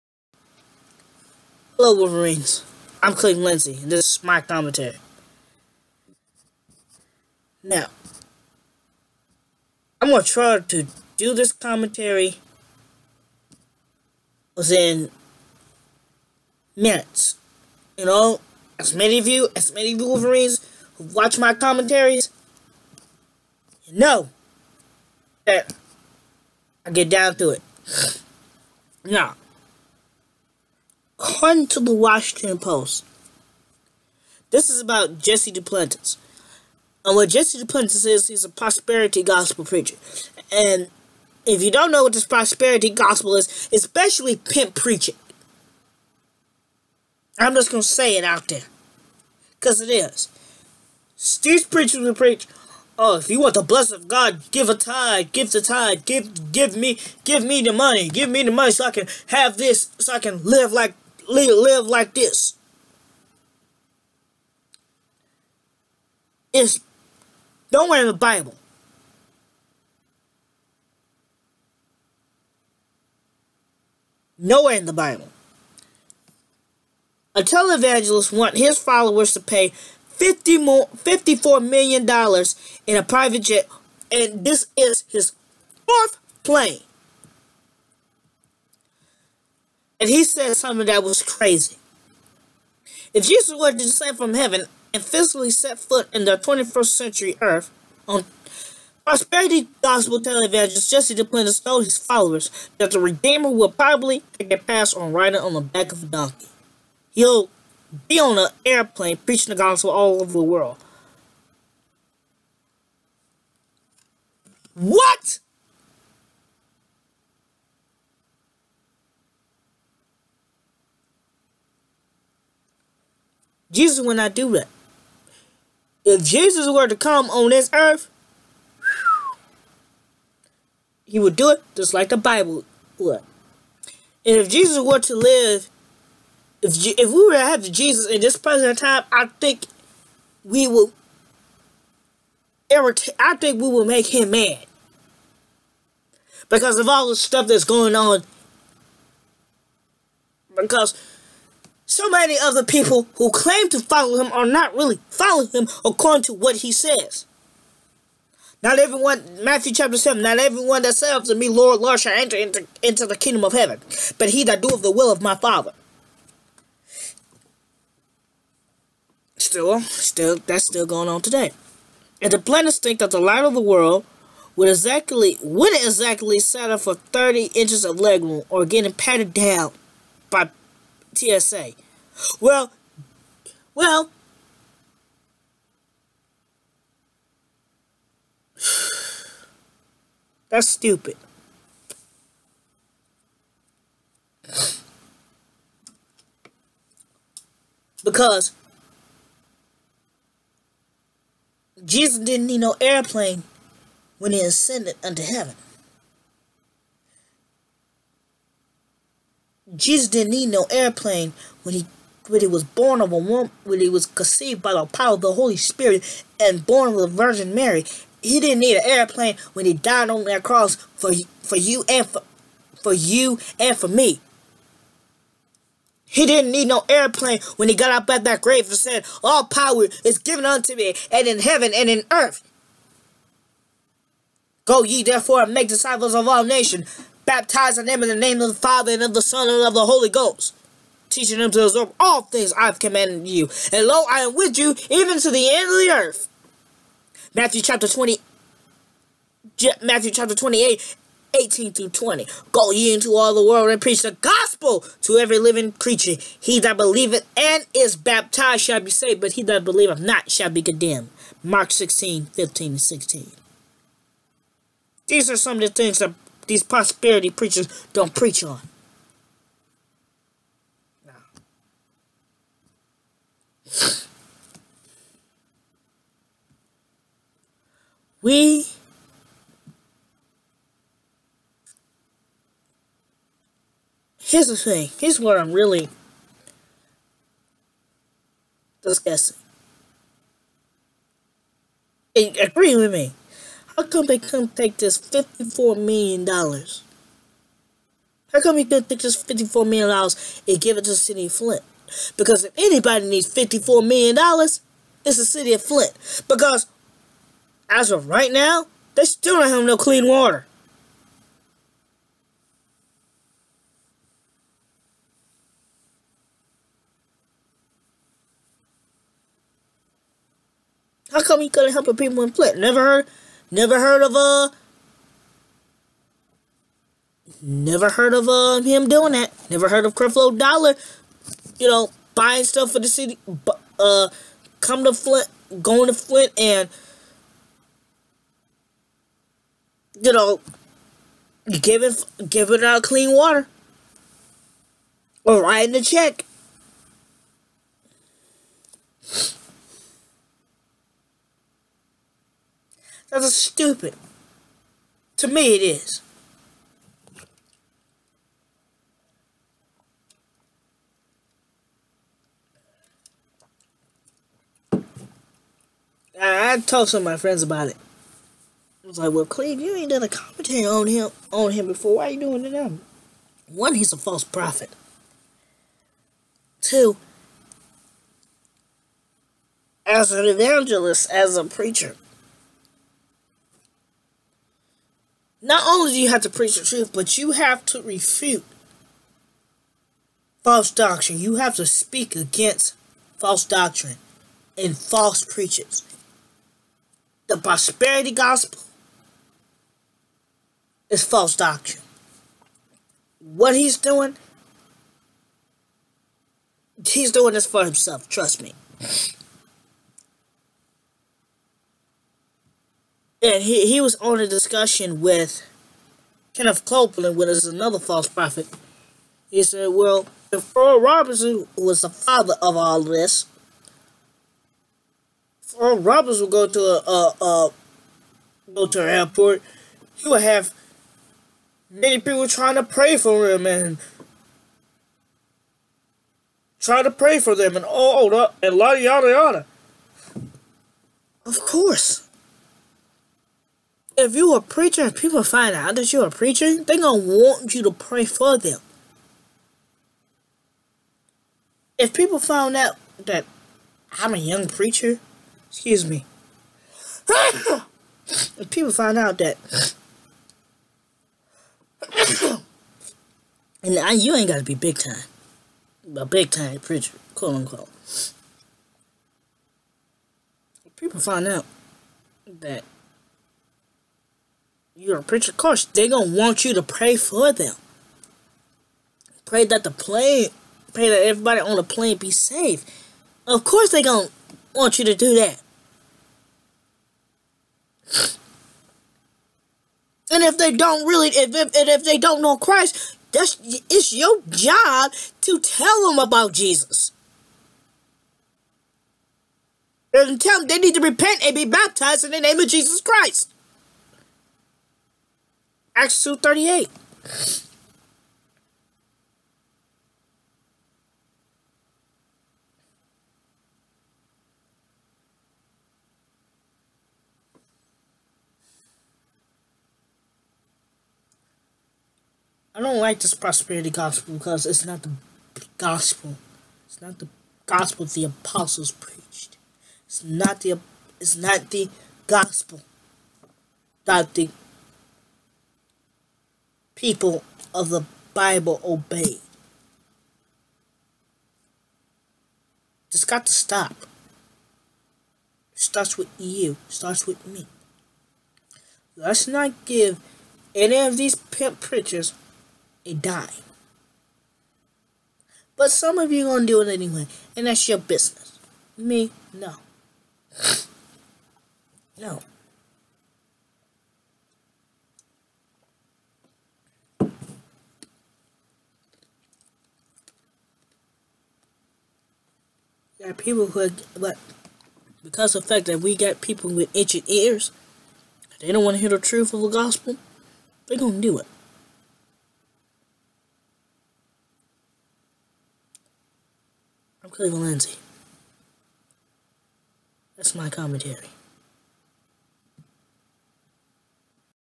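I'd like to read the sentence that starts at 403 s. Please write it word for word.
What he's doing, he's doing this for himself, trust me.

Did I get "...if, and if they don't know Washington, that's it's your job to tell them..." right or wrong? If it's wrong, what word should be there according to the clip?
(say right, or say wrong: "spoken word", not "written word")
wrong: "Christ", not "Washington".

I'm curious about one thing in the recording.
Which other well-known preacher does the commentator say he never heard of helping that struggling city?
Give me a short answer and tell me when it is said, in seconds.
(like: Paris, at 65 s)
Creflo Dollar, at 329 s.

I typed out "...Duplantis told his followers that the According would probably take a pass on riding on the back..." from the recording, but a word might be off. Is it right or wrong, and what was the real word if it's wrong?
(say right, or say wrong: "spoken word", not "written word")
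wrong: "Redeemer", not "According".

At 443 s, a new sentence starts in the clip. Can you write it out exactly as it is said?
If you are preacher, if people find out that you are preaching, they're going to want you to pray for them.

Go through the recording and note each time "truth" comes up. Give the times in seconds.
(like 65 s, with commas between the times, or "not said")
386 s, 578 s.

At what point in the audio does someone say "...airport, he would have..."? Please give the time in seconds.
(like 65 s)
428 s.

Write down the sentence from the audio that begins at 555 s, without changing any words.
But some of you are going to do it anyway.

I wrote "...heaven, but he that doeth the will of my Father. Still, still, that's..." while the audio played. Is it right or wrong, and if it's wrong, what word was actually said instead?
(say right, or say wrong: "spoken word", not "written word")
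right.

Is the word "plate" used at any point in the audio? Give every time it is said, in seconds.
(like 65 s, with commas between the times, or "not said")
not said.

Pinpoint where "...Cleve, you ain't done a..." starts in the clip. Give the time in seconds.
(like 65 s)
369 s.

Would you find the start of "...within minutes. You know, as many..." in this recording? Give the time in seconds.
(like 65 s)
14 s.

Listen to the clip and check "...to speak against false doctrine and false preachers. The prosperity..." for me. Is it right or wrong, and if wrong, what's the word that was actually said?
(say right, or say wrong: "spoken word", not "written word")
right.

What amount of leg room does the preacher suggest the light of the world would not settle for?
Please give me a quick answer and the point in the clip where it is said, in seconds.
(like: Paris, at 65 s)
30 inches, at 176 s.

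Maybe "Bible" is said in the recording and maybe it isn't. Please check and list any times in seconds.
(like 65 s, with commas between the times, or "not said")
68 s, 74 s, 132 s, 538 s.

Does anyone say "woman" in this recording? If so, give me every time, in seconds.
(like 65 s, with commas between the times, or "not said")
213 s.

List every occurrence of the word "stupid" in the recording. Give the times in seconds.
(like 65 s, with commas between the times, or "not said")
190 s, 353 s.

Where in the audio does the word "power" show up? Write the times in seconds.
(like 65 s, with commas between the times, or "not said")
214 s, 229 s.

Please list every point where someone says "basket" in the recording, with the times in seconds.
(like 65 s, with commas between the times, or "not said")
not said.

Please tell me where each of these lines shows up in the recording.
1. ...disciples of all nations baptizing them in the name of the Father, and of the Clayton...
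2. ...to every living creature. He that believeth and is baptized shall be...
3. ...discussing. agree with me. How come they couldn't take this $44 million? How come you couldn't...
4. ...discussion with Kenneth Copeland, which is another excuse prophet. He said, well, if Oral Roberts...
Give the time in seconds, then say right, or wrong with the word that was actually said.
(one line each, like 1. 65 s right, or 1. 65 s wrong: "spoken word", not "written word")
1. 235 s wrong: "Son", not "Clayton"
2. 255 s right
3. 288 s wrong: "54", not "44"
4. 414 s wrong: "false", not "excuse".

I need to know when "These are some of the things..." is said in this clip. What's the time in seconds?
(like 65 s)
265 s.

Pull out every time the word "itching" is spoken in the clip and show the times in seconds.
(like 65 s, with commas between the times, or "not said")
576 s.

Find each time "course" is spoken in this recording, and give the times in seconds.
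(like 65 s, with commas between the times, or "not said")
441 s, 475 s, 483 s.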